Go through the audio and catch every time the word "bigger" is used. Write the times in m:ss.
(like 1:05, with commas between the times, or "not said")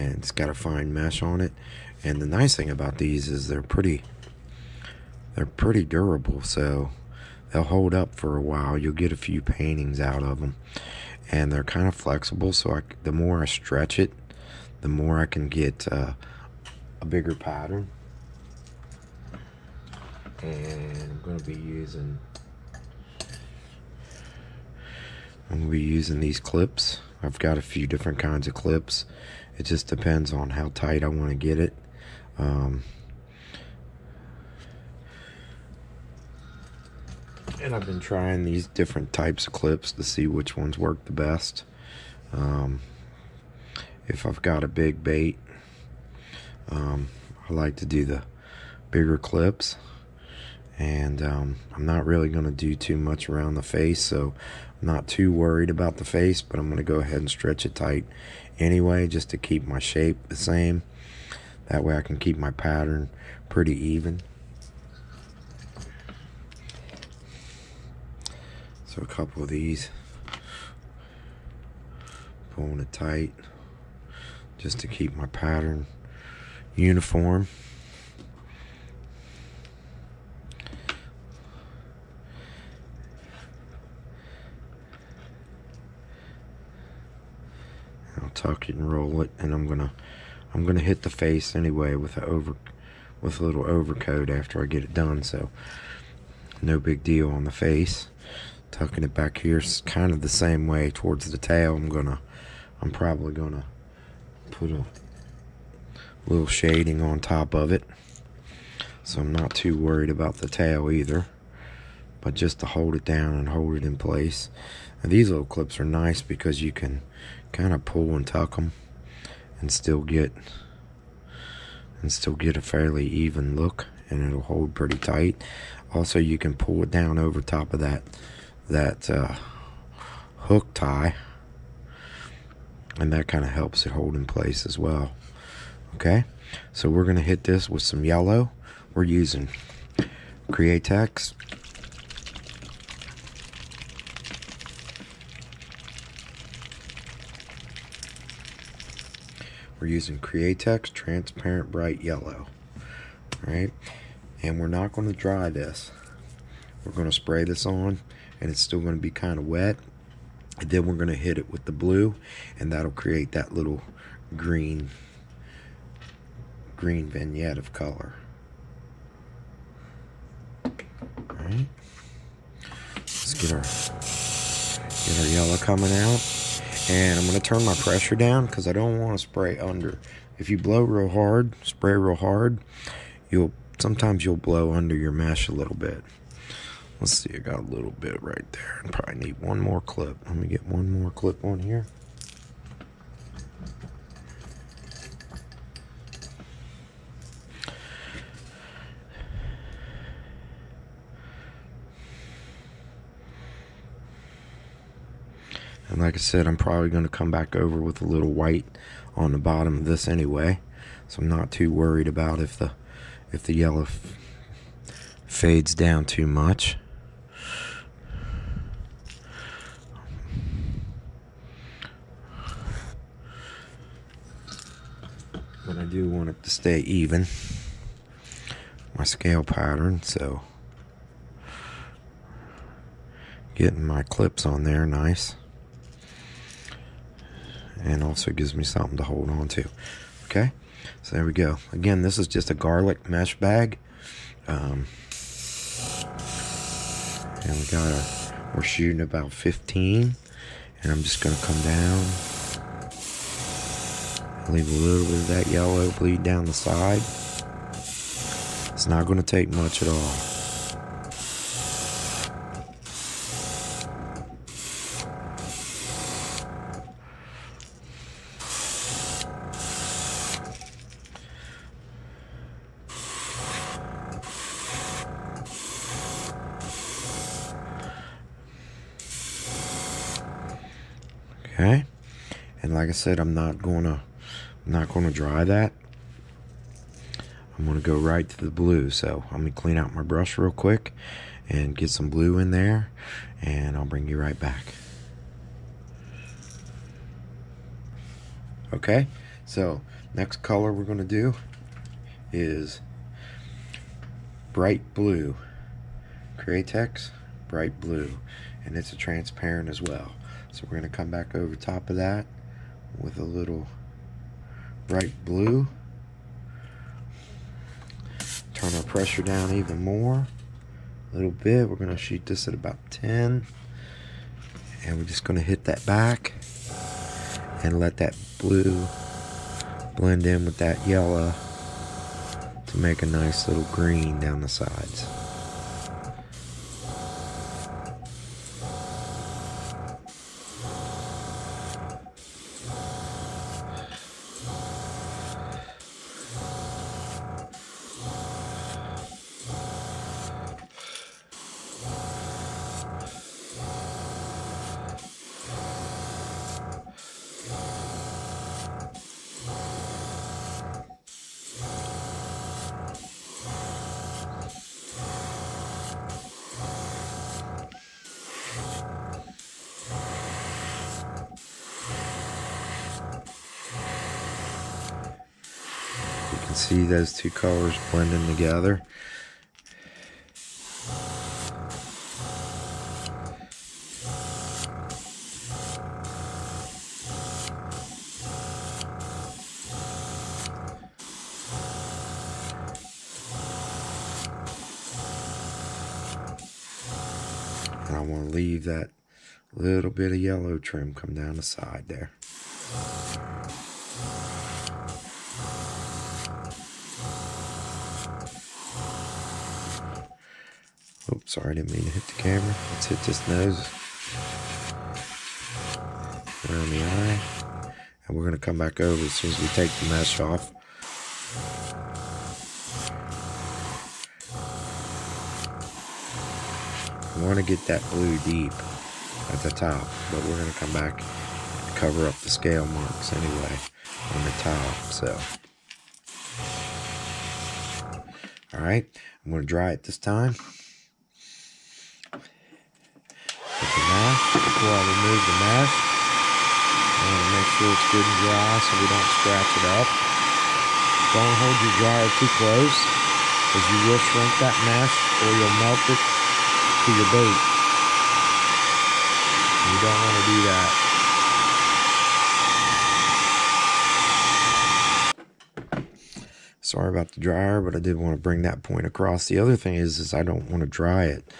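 0:17, 0:48.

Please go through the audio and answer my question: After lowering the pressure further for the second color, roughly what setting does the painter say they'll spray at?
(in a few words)
10.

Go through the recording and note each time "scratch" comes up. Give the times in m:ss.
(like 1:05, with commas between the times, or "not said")
7:29.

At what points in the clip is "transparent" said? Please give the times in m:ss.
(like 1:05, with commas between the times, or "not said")
2:30, 5:08.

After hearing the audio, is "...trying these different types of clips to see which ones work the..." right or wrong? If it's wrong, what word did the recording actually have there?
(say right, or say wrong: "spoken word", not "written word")
right.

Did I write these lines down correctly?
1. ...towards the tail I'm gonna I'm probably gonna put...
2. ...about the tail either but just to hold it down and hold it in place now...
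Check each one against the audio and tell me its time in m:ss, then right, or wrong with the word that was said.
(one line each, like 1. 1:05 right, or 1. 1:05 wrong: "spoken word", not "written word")
1. 1:40 right
2. 1:50 right.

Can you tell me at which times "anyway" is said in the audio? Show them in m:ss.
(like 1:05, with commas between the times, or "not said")
0:58, 1:31, 3:30, 7:13.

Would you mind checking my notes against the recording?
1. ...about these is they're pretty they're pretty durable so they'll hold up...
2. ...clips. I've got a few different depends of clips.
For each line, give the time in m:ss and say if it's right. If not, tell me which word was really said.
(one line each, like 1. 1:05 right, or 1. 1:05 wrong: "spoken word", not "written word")
1. 0:02 right
2. 0:26 wrong: "kinds", not "depends".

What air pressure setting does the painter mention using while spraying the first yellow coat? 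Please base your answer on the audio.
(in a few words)
15.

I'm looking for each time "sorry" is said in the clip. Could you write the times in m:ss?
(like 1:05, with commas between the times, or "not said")
6:51, 7:46.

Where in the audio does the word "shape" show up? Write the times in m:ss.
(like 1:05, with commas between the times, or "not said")
0:59.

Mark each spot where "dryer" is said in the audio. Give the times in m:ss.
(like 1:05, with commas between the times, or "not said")
7:31, 7:47.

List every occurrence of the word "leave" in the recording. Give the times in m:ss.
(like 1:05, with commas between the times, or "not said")
4:14, 6:38.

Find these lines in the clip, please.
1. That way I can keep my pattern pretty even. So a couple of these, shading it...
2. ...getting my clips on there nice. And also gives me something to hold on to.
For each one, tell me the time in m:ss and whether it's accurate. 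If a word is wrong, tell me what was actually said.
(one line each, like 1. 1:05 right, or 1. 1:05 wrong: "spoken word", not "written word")
1. 1:01 wrong: "pulling", not "shading"
2. 3:53 right.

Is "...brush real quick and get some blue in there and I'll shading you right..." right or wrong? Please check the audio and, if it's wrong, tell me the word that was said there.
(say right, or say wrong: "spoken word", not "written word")
wrong: "bring", not "shading".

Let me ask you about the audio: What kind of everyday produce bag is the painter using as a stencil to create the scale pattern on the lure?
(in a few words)
Garlic mesh bag.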